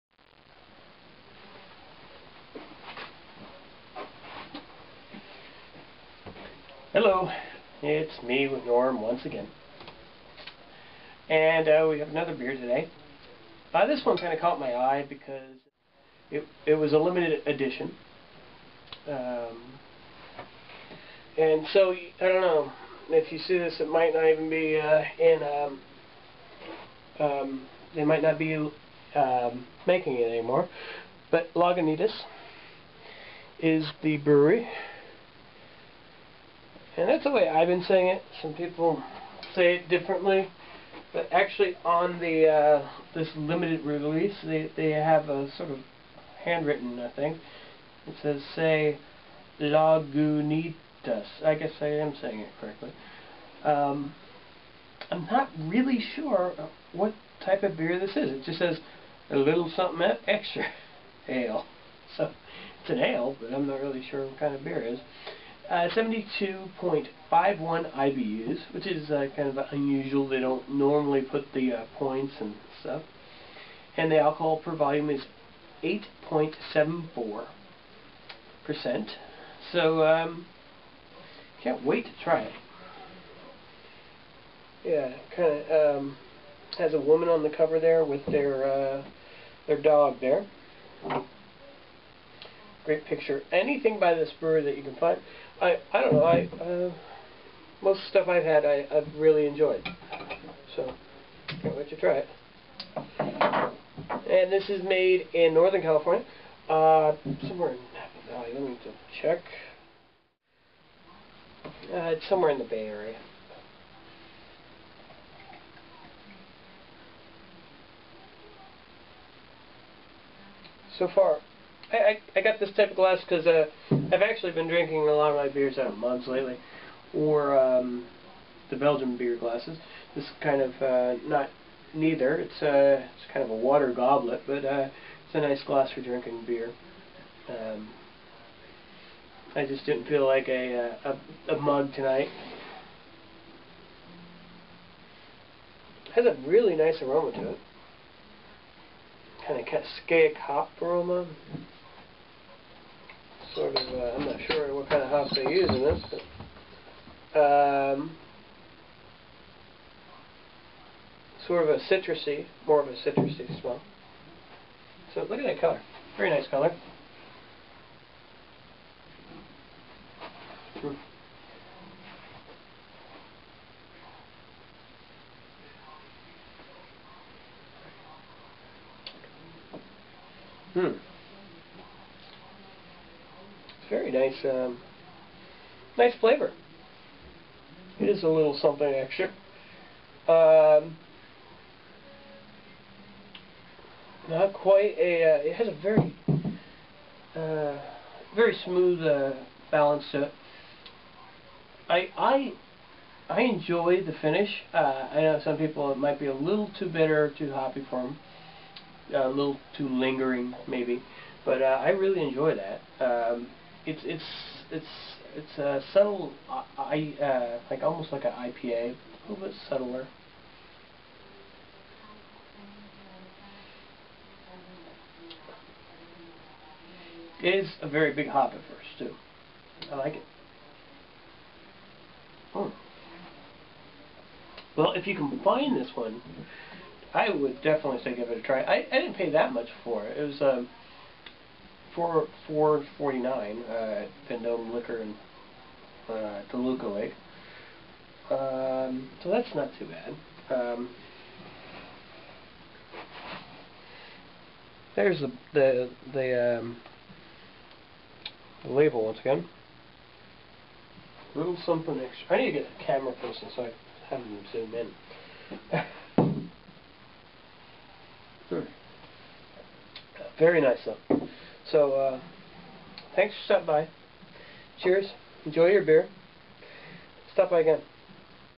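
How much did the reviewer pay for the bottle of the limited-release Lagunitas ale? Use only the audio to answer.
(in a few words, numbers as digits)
$4.49.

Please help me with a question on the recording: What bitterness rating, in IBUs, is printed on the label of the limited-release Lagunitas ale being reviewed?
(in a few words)
72.51.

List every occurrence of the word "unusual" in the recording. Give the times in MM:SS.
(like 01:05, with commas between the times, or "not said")
01:09.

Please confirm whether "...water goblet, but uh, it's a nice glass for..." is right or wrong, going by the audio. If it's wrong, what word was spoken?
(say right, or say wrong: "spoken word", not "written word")
right.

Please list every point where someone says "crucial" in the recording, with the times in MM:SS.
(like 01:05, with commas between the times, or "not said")
not said.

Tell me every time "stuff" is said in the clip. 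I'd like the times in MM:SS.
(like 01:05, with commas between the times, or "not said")
01:12, 01:38.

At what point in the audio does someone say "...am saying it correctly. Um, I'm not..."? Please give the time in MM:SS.
00:51.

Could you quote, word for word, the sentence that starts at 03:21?
I I I enjoy the finish.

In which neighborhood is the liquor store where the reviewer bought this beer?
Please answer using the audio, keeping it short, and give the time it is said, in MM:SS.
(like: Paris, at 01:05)
Toluca Lake, at 04:06.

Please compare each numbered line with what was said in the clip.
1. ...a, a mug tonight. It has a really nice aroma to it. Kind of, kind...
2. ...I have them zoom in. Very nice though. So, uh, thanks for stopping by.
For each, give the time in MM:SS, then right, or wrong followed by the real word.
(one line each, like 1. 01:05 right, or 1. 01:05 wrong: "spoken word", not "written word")
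1. 02:21 right
2. 04:23 right.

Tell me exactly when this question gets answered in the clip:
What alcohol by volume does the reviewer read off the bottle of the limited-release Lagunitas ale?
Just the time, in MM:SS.
01:15.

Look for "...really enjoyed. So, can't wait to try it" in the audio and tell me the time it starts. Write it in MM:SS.
01:39.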